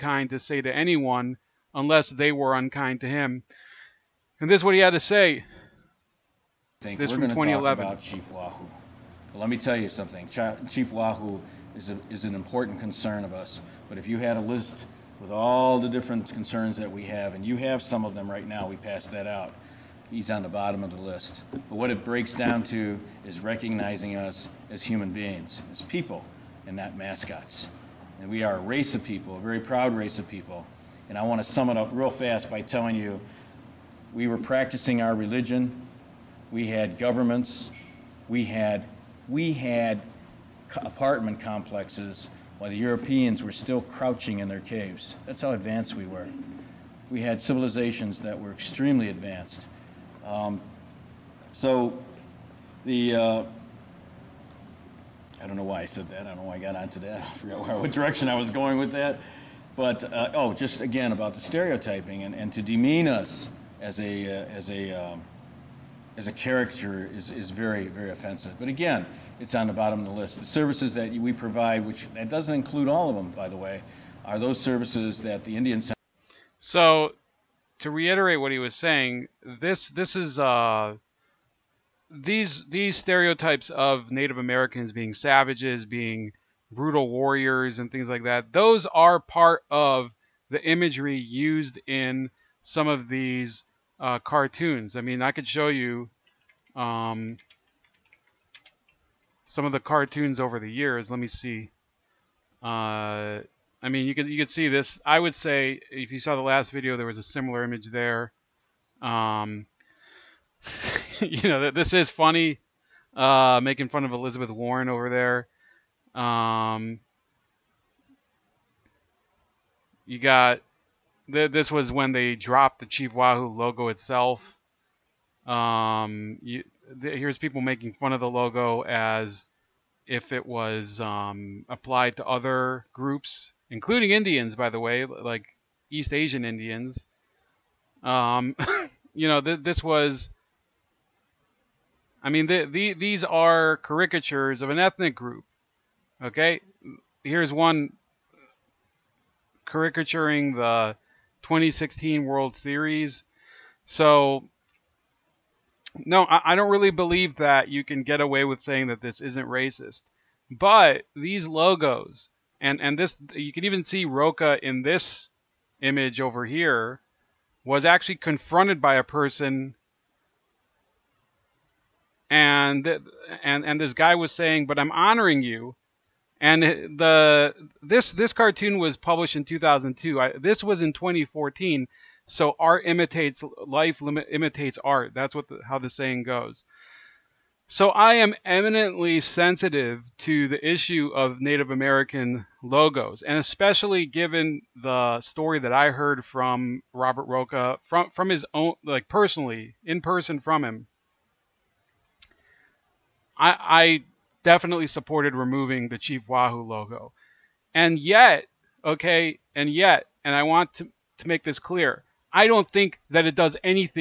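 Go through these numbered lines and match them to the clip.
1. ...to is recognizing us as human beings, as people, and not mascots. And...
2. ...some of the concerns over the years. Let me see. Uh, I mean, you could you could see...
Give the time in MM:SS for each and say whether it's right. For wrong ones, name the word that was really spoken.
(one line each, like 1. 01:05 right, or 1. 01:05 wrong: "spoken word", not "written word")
1. 00:22 right
2. 01:39 wrong: "cartoons", not "concerns".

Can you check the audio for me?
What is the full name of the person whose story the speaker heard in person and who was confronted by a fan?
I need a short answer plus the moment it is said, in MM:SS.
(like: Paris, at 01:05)
Robert Roca, at 03:16.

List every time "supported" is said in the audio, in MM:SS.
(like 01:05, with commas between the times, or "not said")
03:24.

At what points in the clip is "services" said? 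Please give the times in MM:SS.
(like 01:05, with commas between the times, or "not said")
01:10, 01:14.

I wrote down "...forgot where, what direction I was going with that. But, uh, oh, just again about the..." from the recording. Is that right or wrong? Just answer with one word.
right.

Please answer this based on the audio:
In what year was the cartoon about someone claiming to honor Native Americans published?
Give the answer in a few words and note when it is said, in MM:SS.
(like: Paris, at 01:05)
2002, at 02:59.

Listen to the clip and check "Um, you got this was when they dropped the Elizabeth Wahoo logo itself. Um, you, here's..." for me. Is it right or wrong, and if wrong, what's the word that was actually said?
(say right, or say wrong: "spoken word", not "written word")
wrong: "Chief", not "Elizabeth".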